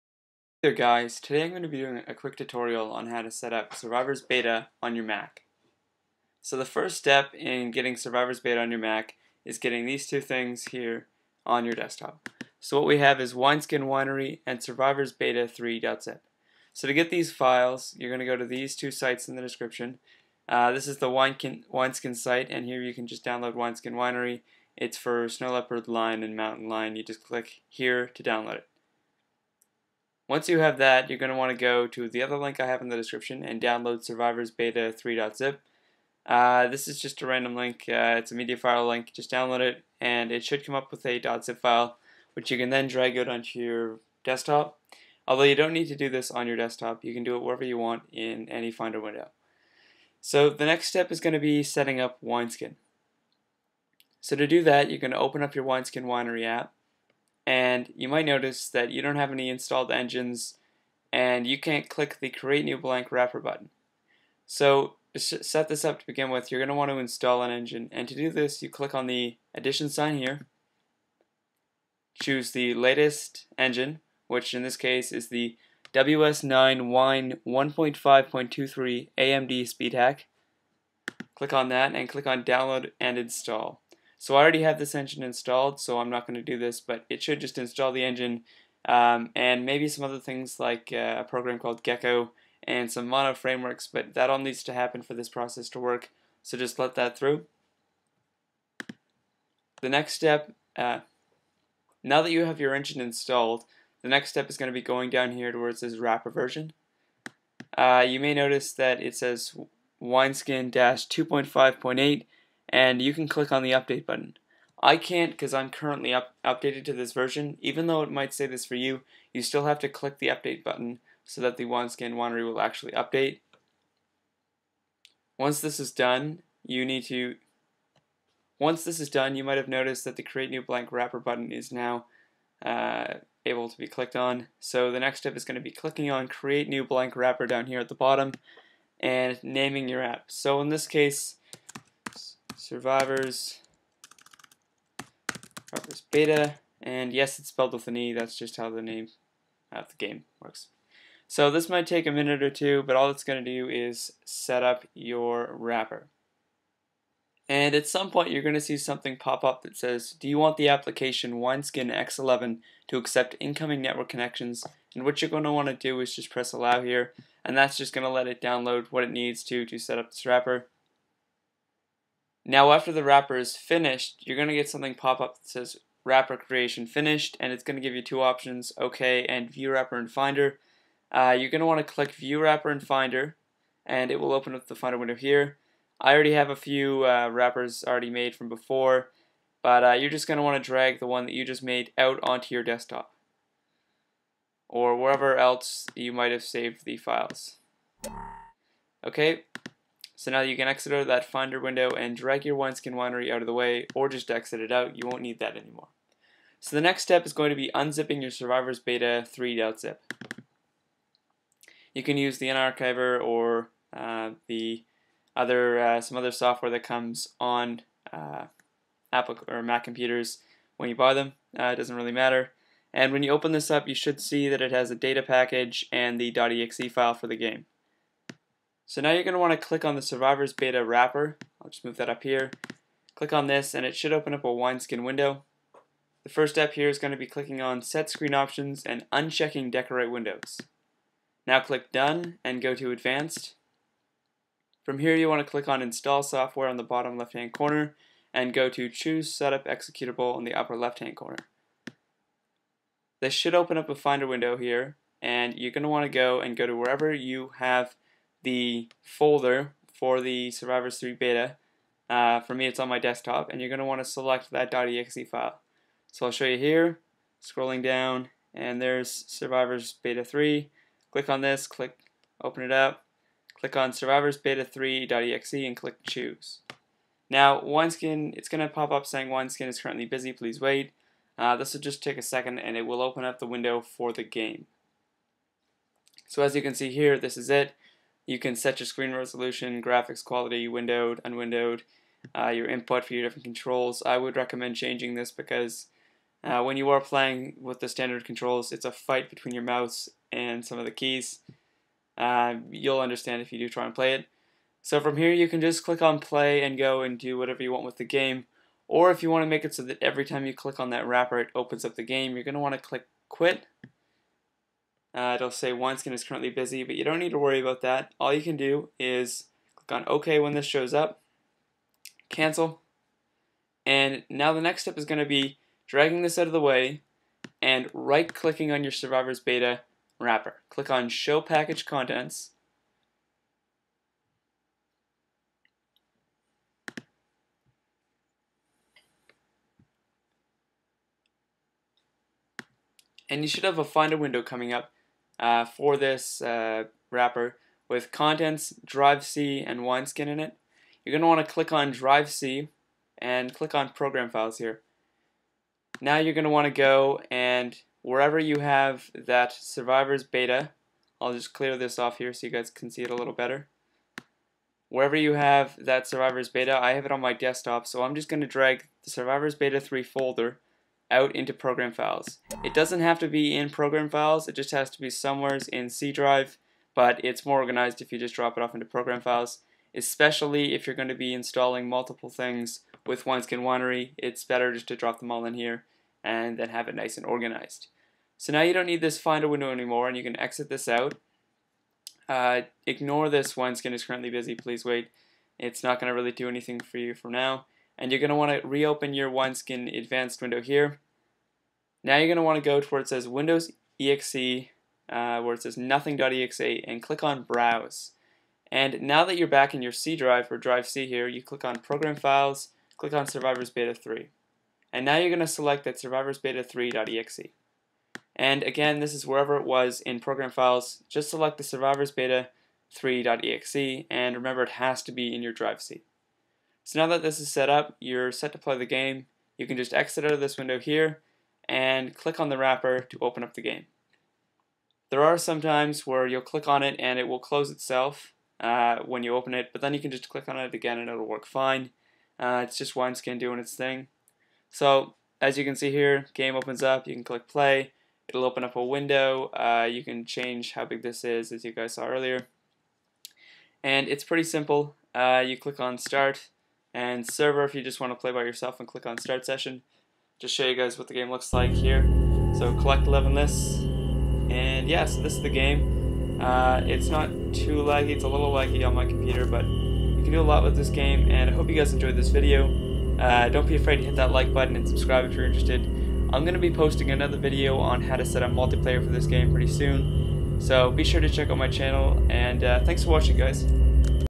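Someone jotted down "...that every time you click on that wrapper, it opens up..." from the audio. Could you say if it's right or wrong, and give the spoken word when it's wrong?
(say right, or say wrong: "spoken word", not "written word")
right.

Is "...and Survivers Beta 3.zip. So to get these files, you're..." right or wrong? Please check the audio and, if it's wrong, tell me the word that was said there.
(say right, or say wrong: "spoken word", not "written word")
right.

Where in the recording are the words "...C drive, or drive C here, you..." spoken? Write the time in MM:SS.
06:49.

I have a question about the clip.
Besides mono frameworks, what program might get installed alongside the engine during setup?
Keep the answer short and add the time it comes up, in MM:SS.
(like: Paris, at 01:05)
Gecko, at 01:31.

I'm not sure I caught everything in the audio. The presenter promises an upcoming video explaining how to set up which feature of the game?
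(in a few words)
Multiplayer.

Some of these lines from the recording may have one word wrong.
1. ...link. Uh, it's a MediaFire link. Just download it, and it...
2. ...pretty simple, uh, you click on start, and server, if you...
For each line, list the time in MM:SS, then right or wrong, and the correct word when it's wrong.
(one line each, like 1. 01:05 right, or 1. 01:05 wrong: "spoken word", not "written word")
1. 00:37 right
2. 07:34 right.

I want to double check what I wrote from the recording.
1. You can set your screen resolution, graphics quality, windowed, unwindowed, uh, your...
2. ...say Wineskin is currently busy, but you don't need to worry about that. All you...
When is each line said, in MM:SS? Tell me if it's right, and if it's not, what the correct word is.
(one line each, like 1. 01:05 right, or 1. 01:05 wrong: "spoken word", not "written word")
1. 04:48 right
2. 05:15 right.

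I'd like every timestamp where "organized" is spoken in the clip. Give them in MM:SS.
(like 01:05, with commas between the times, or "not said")
06:17, 06:27.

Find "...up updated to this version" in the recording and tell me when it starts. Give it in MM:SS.
01:56.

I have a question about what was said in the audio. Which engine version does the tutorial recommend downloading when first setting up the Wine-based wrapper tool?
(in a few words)
WS9 Wine 1.5.23 AMD Speed Hack.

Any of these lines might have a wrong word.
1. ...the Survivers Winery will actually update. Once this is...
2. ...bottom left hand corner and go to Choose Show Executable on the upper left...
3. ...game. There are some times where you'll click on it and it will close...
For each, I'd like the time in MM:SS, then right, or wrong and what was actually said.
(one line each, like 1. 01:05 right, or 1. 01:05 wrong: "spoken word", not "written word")
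1. 02:01 wrong: "Wineskin", not "Survivers"
2. 04:06 wrong: "Setup", not "Show"
3. 07:13 right.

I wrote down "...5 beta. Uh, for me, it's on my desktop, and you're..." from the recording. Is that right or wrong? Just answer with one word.
wrong.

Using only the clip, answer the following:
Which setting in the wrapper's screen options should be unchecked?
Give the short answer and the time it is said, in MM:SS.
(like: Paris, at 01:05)
Decorate Windows, at 03:59.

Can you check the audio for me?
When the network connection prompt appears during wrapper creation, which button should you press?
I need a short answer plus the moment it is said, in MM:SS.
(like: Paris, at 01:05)
Allow, at 02:46.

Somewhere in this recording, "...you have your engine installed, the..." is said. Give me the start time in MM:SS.
01:42.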